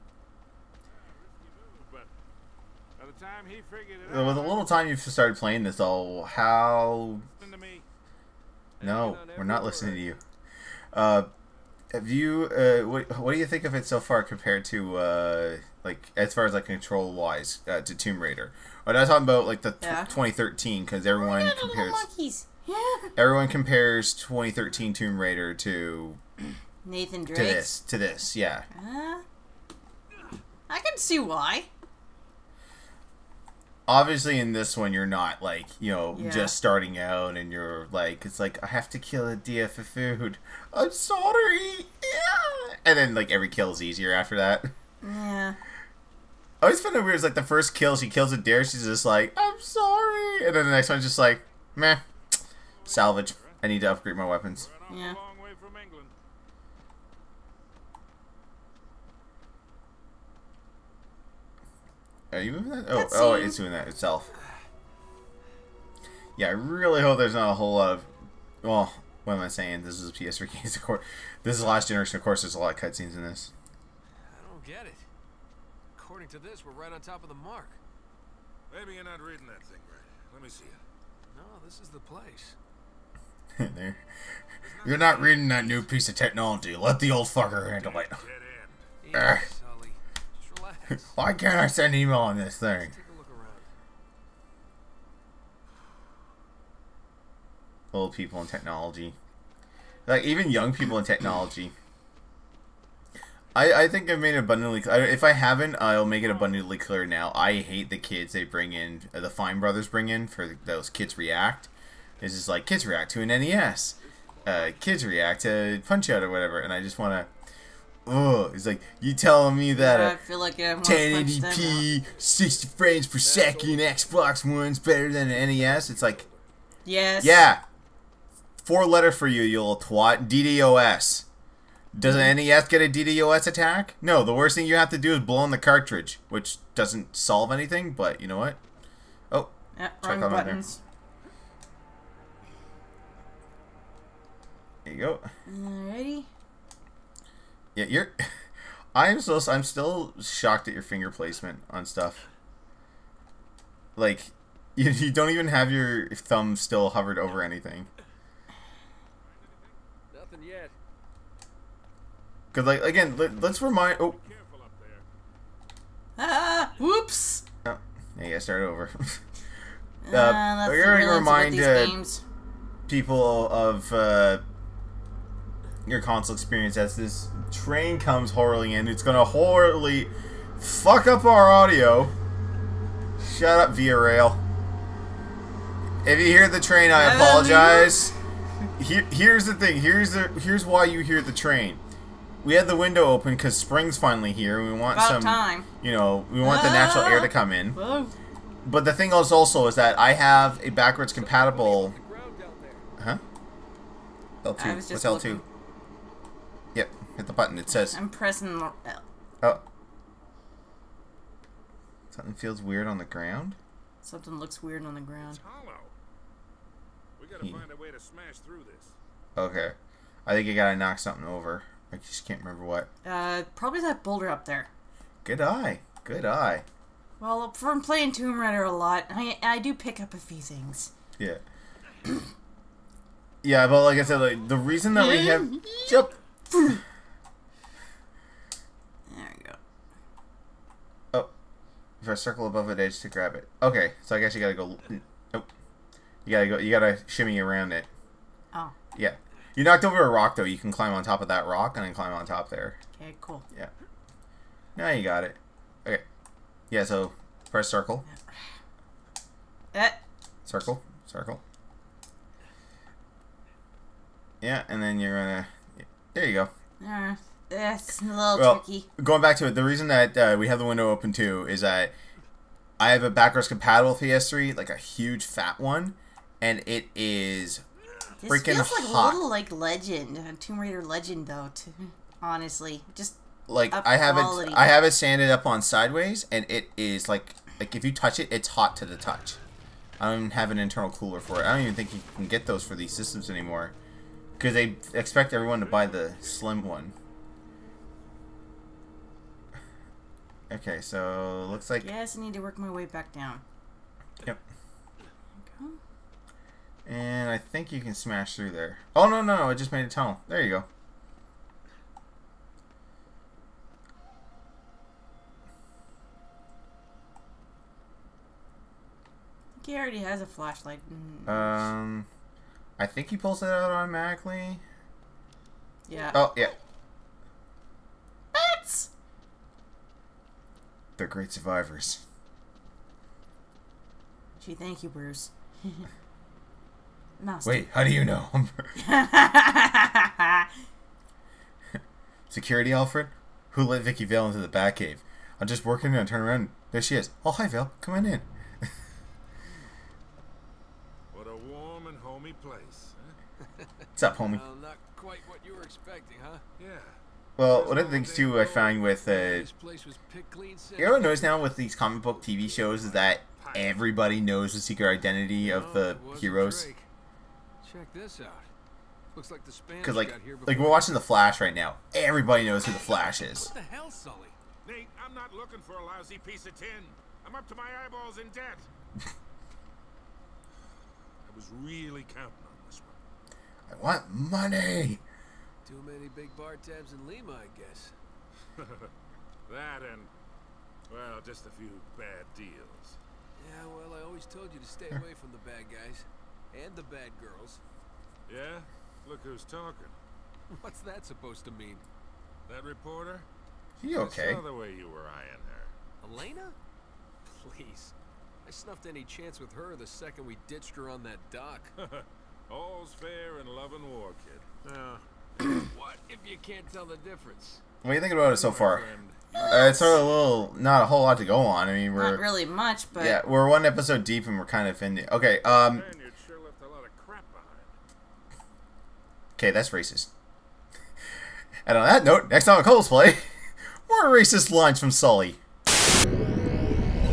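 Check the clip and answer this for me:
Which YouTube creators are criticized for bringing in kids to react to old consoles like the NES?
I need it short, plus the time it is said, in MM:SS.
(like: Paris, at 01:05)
Fine Brothers, at 01:49.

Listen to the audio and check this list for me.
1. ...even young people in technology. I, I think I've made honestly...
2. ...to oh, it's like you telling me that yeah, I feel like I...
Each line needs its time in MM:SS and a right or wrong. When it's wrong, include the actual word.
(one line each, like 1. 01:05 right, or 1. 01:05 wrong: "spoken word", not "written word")
1. 01:40 wrong: "abundantly", not "honestly"
2. 01:57 right.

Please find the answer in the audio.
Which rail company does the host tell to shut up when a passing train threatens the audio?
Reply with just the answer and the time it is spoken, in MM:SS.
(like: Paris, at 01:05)
Via Rail, at 03:03.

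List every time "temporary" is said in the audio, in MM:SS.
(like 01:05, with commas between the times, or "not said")
not said.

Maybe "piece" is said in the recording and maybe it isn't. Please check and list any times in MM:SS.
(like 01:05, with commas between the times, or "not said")
01:25, 06:16.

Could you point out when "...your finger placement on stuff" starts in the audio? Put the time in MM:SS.
02:30.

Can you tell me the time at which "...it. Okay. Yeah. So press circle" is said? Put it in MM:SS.
04:15.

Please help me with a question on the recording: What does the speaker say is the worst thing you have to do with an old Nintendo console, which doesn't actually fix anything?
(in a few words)
blow on the cartridge.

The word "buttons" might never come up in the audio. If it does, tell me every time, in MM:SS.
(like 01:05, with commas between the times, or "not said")
02:20, 03:27.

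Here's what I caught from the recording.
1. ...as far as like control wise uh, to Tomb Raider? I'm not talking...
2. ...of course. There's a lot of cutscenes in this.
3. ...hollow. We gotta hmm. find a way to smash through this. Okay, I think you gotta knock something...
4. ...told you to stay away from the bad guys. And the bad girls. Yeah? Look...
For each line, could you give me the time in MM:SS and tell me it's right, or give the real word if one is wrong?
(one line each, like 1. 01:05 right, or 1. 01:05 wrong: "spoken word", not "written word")
1. 00:16 right
2. 01:12 right
3. 03:35 right
4. 06:34 right.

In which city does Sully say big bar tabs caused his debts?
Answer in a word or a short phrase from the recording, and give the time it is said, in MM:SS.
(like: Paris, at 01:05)
Lima, at 06:27.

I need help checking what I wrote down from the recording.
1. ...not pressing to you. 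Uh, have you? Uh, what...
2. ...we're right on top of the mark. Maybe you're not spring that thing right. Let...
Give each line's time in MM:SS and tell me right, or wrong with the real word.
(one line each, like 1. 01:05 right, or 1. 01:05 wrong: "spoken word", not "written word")
1. 00:09 wrong: "listening", not "pressing"
2. 01:16 wrong: "reading", not "spring".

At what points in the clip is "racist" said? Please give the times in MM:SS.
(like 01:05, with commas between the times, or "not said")
07:09, 07:14.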